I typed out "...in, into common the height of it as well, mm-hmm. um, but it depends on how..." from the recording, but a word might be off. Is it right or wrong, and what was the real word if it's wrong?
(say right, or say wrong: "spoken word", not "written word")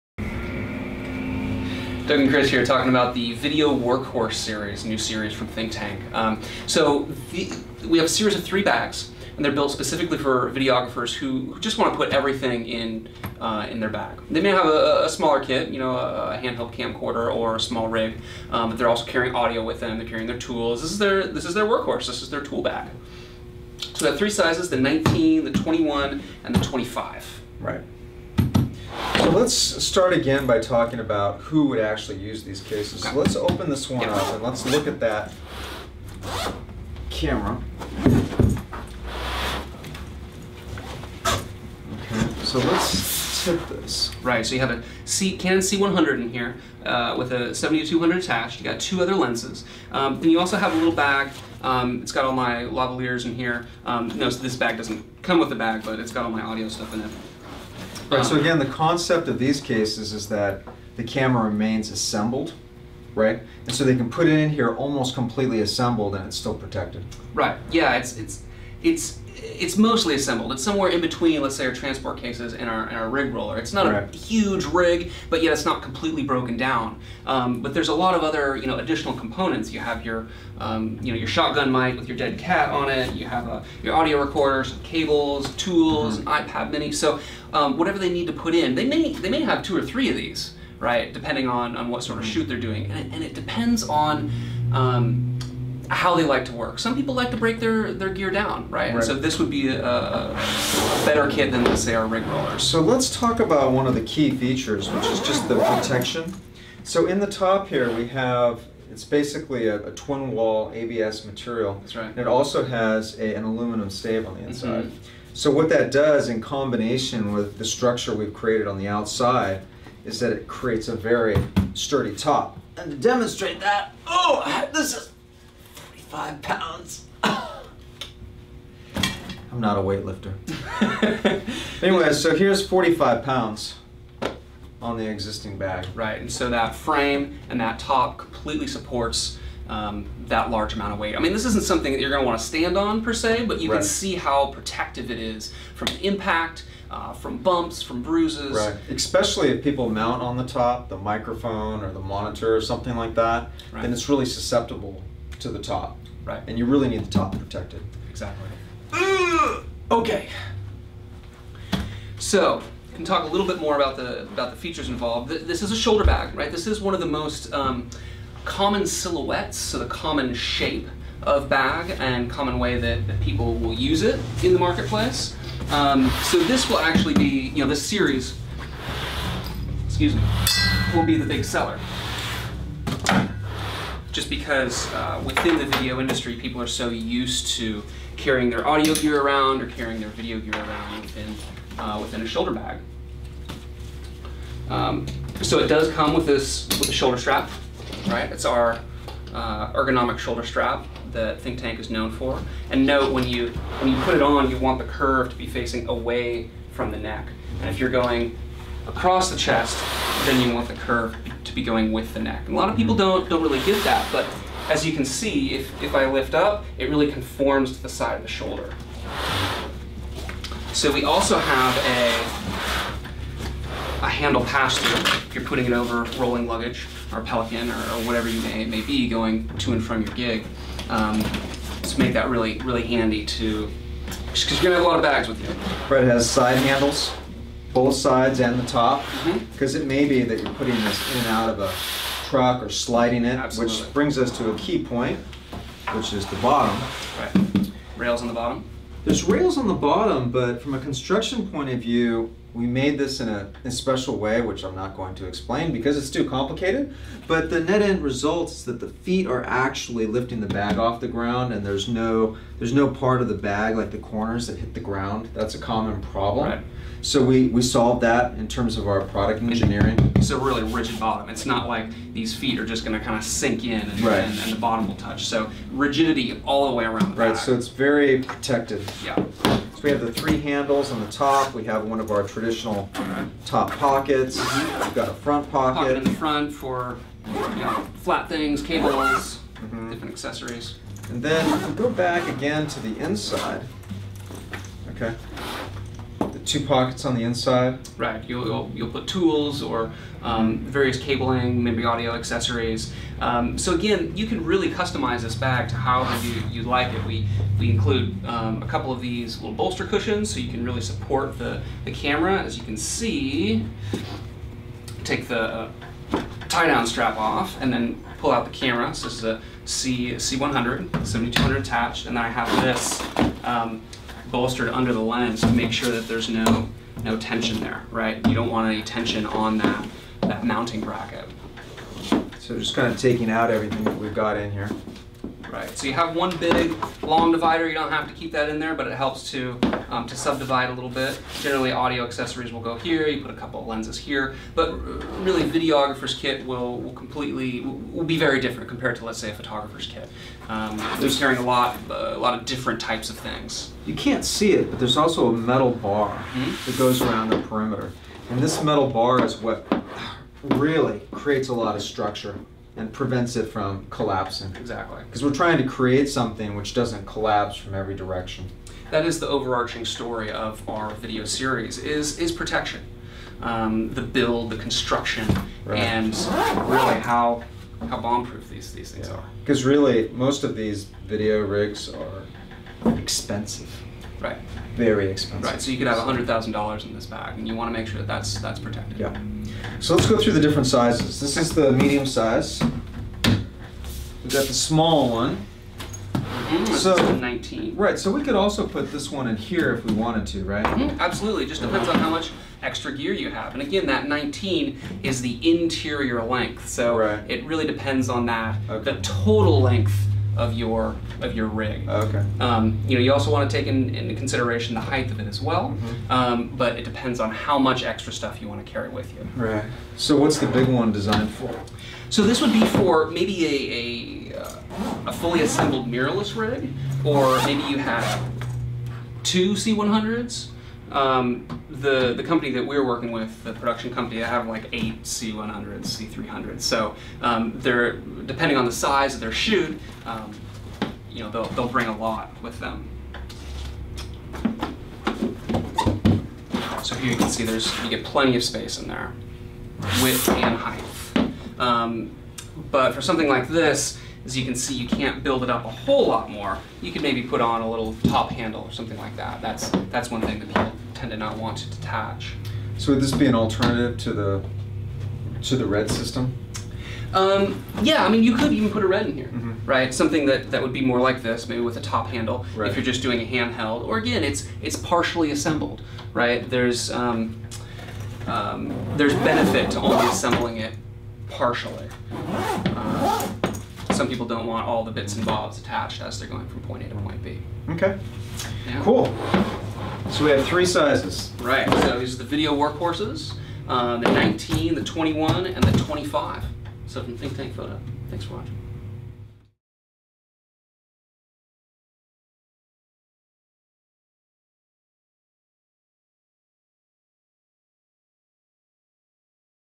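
wrong: "consideration", not "common".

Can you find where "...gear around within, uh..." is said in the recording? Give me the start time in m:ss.
3:10.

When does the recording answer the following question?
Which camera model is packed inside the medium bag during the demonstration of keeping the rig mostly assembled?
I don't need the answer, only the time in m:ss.
0:45.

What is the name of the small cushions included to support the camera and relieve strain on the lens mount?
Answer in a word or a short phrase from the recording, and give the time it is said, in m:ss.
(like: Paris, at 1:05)
Bolster cushions, at 5:09.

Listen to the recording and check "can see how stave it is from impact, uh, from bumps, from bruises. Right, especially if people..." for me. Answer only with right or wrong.
wrong.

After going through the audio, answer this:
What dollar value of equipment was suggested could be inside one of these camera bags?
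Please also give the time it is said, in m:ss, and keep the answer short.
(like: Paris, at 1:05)
$100,000, at 6:25.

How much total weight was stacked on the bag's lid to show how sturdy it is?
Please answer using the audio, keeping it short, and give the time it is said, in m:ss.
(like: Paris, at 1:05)
45 pounds, at 2:12.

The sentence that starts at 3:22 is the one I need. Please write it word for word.
And note when you when you put it on, you want the curve to be facing away from the neck.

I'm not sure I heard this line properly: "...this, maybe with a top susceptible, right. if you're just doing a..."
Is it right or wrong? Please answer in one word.
wrong.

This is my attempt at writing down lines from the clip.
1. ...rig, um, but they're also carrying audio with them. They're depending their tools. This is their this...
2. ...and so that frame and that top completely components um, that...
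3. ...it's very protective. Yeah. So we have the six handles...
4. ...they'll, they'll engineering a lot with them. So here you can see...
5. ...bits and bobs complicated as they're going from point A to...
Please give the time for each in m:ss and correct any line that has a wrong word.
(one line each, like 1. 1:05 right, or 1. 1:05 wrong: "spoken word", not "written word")
1. 0:17 wrong: "carrying", not "depending"
2. 2:16 wrong: "supports", not "components"
3. 4:37 wrong: "three", not "six"
4. 7:21 wrong: "bring", not "engineering"
5. 8:04 wrong: "attached", not "complicated".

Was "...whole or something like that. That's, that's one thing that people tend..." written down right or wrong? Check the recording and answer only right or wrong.
wrong.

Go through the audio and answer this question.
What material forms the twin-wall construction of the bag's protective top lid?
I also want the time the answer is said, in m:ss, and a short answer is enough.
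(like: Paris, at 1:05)
ABS, at 1:50.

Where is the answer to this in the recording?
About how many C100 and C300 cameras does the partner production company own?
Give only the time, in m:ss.
7:14.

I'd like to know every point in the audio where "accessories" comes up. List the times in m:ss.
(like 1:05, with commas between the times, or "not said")
4:50, 5:02, 5:42.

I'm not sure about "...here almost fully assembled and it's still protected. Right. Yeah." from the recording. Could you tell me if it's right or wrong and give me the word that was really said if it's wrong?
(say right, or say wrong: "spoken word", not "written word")
wrong: "completely", not "fully".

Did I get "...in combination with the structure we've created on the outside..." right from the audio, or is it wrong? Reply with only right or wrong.
right.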